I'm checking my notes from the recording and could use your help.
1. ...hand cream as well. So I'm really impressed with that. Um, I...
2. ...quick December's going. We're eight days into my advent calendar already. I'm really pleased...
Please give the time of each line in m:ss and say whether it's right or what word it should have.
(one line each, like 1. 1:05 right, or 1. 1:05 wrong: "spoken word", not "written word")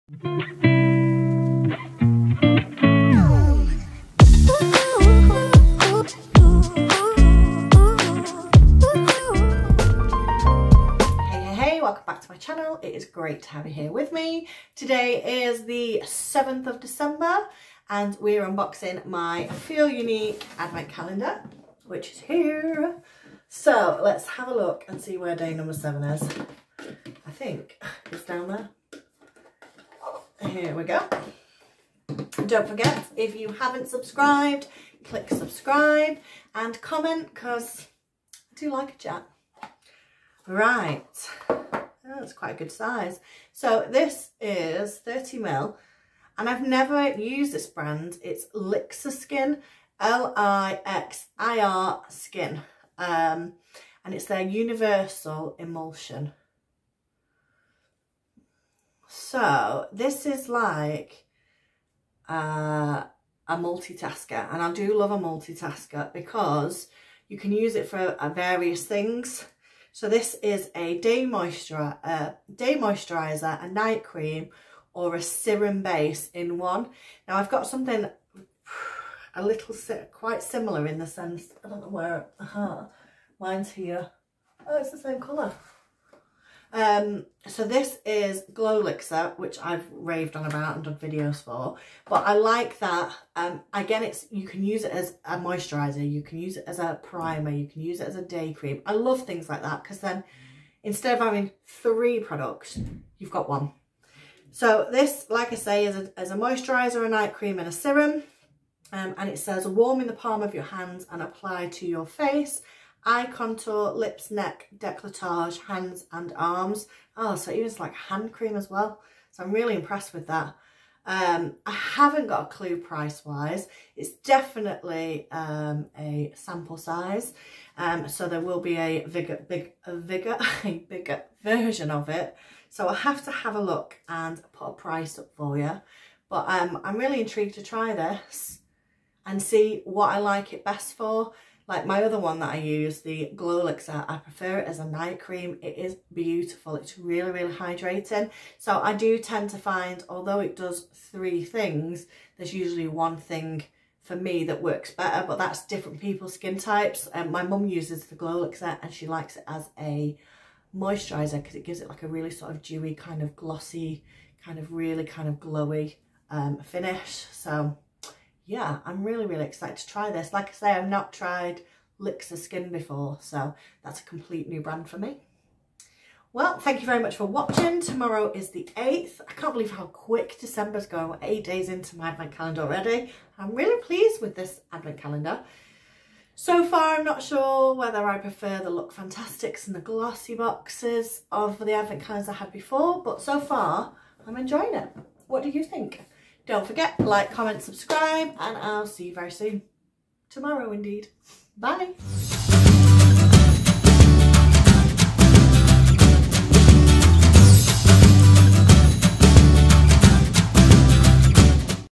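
1. 1:57 right
2. 2:59 right.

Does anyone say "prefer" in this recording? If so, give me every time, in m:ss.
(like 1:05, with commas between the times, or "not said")
2:24, 3:08.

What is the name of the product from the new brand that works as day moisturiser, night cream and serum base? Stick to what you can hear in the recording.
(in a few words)
Universal Emulsion.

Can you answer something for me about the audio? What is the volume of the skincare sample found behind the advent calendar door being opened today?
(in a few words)
30 ml.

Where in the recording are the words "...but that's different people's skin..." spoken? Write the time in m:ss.
2:35.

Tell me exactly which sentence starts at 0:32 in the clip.
Don't forget, if you haven't subscribed, click subscribe and comment because I do like a chat.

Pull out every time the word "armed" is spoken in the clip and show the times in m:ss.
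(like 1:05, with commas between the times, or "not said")
not said.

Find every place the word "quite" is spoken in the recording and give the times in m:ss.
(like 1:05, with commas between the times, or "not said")
0:42, 1:20.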